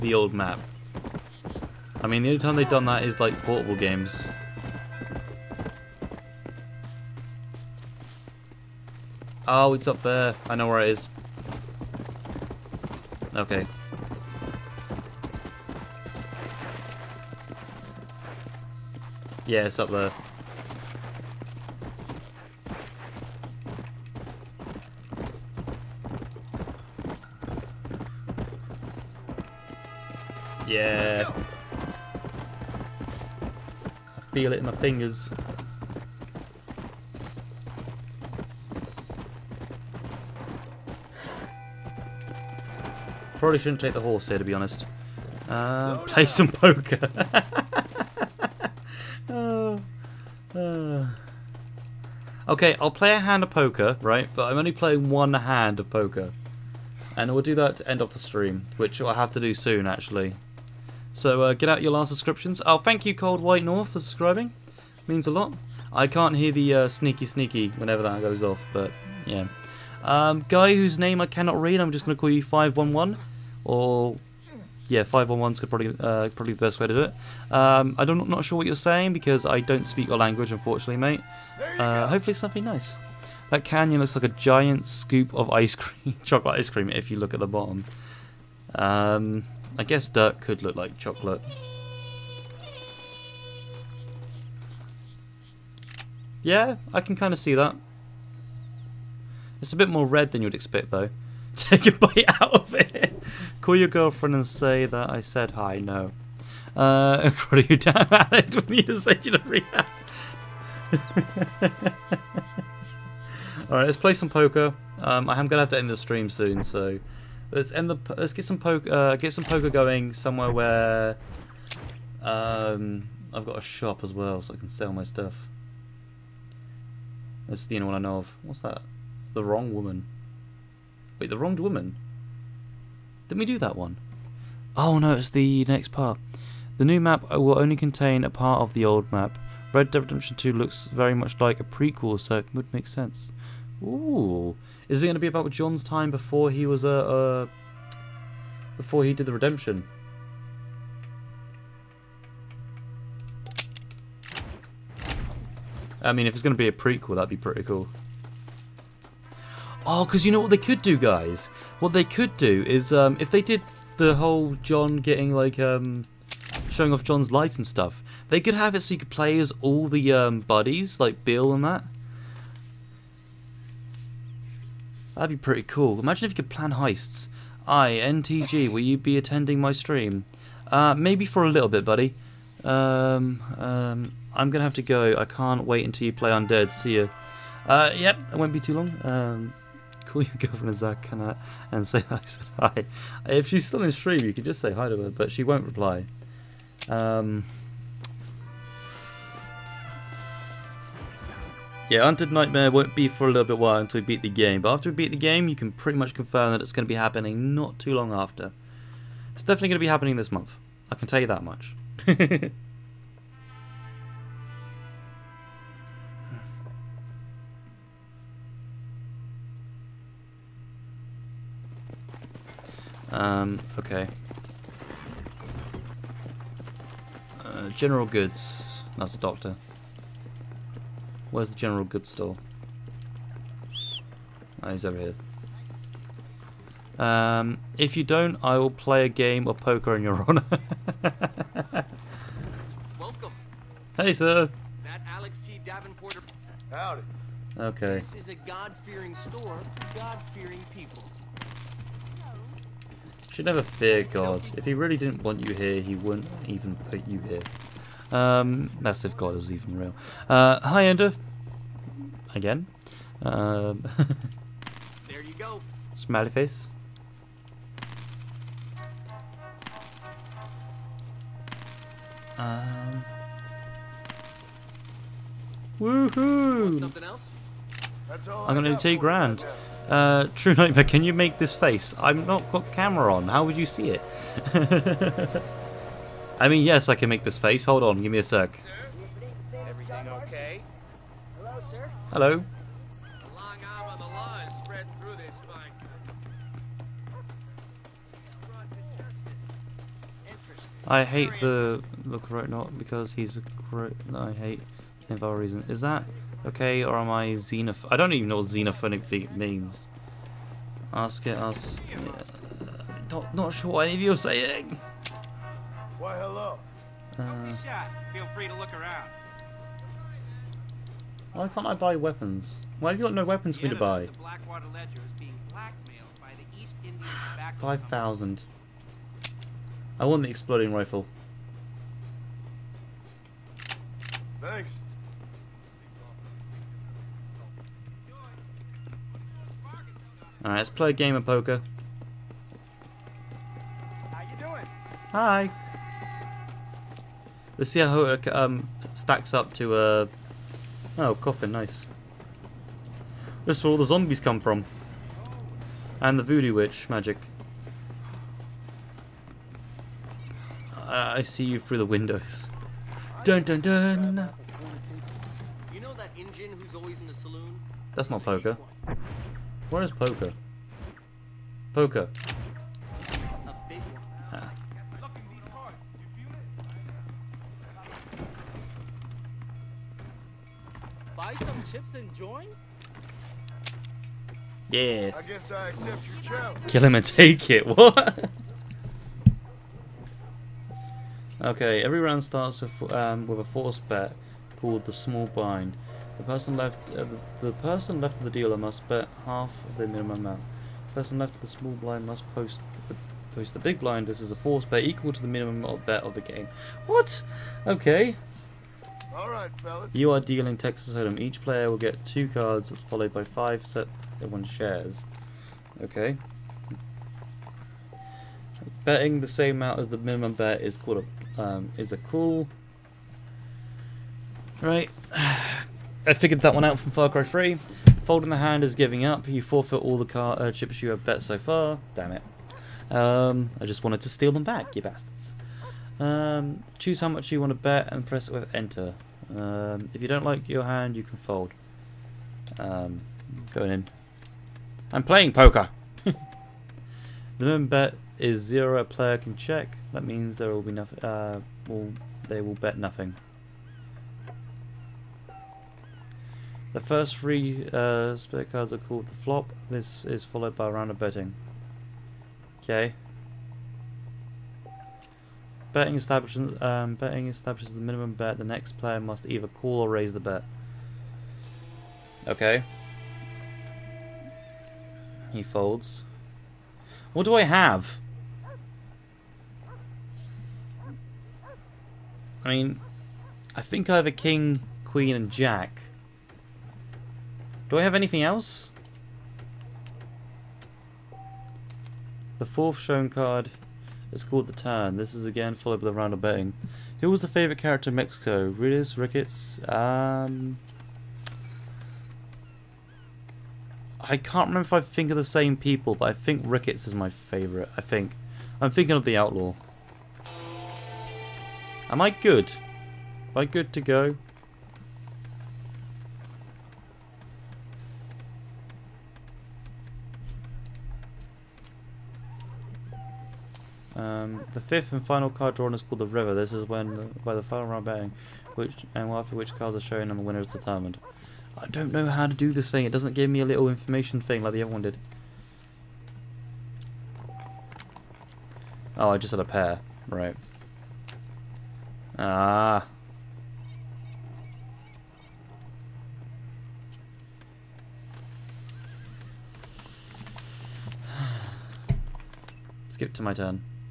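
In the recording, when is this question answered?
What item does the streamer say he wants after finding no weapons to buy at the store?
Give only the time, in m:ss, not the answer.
5:30.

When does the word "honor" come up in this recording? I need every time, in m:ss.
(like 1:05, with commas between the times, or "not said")
4:00.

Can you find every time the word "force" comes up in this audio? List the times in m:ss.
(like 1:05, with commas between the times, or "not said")
6:33, 6:44.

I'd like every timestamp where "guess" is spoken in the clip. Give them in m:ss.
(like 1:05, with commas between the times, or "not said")
1:29, 6:25.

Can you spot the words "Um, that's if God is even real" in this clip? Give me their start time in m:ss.
4:18.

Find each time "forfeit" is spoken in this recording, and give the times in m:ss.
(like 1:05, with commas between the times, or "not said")
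7:09.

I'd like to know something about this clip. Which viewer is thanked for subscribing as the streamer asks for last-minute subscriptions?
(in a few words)
Cold White North.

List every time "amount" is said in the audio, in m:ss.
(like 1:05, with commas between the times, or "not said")
6:40, 6:59.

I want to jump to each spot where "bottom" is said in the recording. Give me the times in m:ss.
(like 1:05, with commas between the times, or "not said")
1:27.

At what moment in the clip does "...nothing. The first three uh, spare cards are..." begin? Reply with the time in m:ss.
7:32.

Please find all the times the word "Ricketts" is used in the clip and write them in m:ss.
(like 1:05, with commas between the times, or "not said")
8:18, 8:26.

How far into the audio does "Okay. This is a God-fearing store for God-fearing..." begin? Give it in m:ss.
4:07.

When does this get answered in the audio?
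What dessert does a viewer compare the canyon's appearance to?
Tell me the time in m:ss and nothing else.
1:26.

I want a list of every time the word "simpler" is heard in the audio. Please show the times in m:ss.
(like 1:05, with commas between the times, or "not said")
not said.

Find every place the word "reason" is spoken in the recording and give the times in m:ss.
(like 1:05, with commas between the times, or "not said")
5:05.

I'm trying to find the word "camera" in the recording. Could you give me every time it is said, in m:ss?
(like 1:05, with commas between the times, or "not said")
4:42.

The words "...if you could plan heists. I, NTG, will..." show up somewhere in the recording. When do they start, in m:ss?
2:56.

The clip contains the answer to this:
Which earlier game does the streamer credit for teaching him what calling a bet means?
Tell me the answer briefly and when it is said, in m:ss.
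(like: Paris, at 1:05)
Far Cry 3, at 7:06.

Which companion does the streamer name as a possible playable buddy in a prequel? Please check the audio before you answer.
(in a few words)
Bill.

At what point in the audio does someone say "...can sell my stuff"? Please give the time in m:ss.
2:04.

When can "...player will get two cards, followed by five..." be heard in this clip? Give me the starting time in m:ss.
6:51.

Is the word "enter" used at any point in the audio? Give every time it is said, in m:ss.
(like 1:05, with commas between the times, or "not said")
7:18.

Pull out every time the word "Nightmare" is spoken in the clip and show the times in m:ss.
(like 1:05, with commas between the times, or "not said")
3:22, 4:40.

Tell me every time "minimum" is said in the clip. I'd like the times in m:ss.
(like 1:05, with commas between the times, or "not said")
6:39, 6:45, 6:59, 7:27, 7:47.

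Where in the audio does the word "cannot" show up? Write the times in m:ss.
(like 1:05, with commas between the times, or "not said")
1:11, 3:10.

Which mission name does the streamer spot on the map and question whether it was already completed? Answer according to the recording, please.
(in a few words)
The Wronged Woman.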